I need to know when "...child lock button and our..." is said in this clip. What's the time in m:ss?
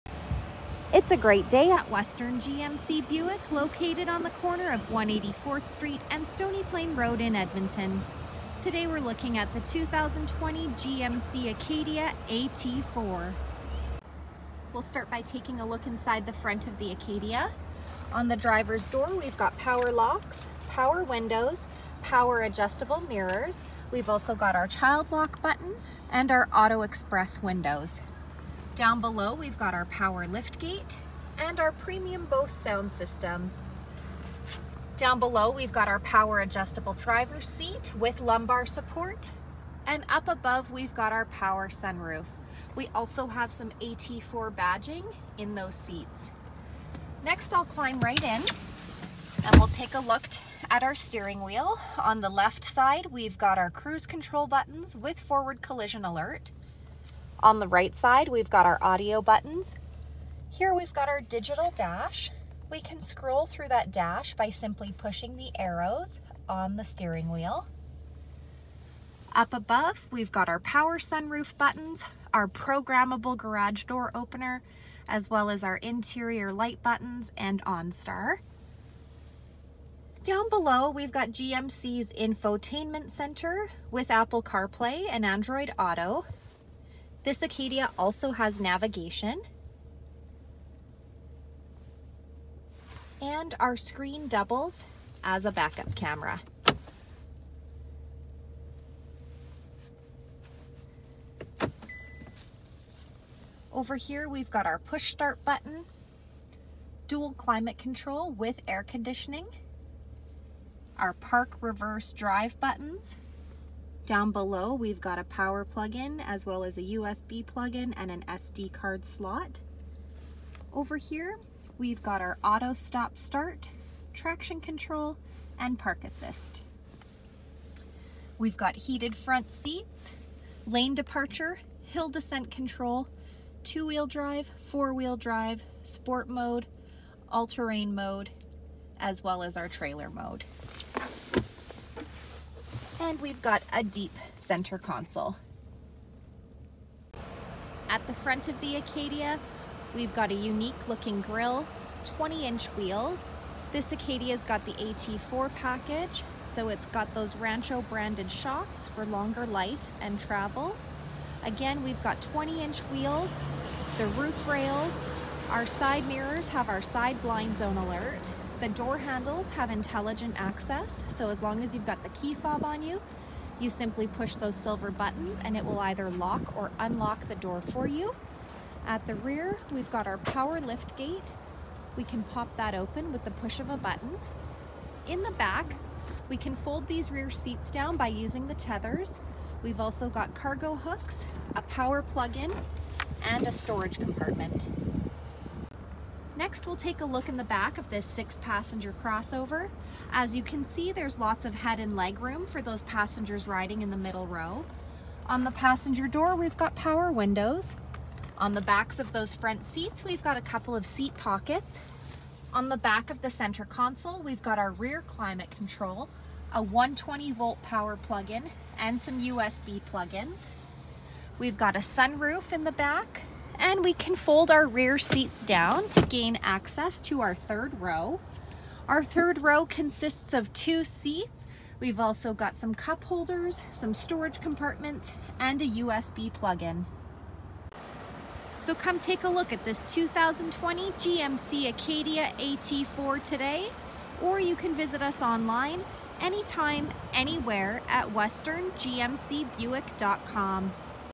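0:24.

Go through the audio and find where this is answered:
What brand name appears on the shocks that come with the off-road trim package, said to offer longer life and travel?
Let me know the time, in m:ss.
2:37.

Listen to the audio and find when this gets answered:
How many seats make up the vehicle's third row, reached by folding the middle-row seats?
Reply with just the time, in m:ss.
3:50.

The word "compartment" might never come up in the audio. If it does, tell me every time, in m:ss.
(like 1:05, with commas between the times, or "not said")
3:13, 3:54.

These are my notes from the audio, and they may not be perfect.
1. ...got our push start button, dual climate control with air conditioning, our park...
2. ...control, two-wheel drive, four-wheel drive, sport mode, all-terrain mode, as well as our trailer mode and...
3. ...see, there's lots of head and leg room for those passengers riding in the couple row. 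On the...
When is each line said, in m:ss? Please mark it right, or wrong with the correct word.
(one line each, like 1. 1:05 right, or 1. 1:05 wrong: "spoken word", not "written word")
1. 1:44 right
2. 2:12 right
3. 3:20 wrong: "middle", not "couple".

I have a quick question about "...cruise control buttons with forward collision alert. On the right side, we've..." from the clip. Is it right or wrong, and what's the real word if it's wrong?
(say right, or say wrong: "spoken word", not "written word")
right.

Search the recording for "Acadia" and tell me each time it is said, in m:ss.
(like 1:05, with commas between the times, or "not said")
0:11, 0:16, 1:27, 2:28, 2:33, 4:01.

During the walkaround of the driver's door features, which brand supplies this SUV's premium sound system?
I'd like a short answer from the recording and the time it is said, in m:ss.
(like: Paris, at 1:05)
Bose, at 0:32.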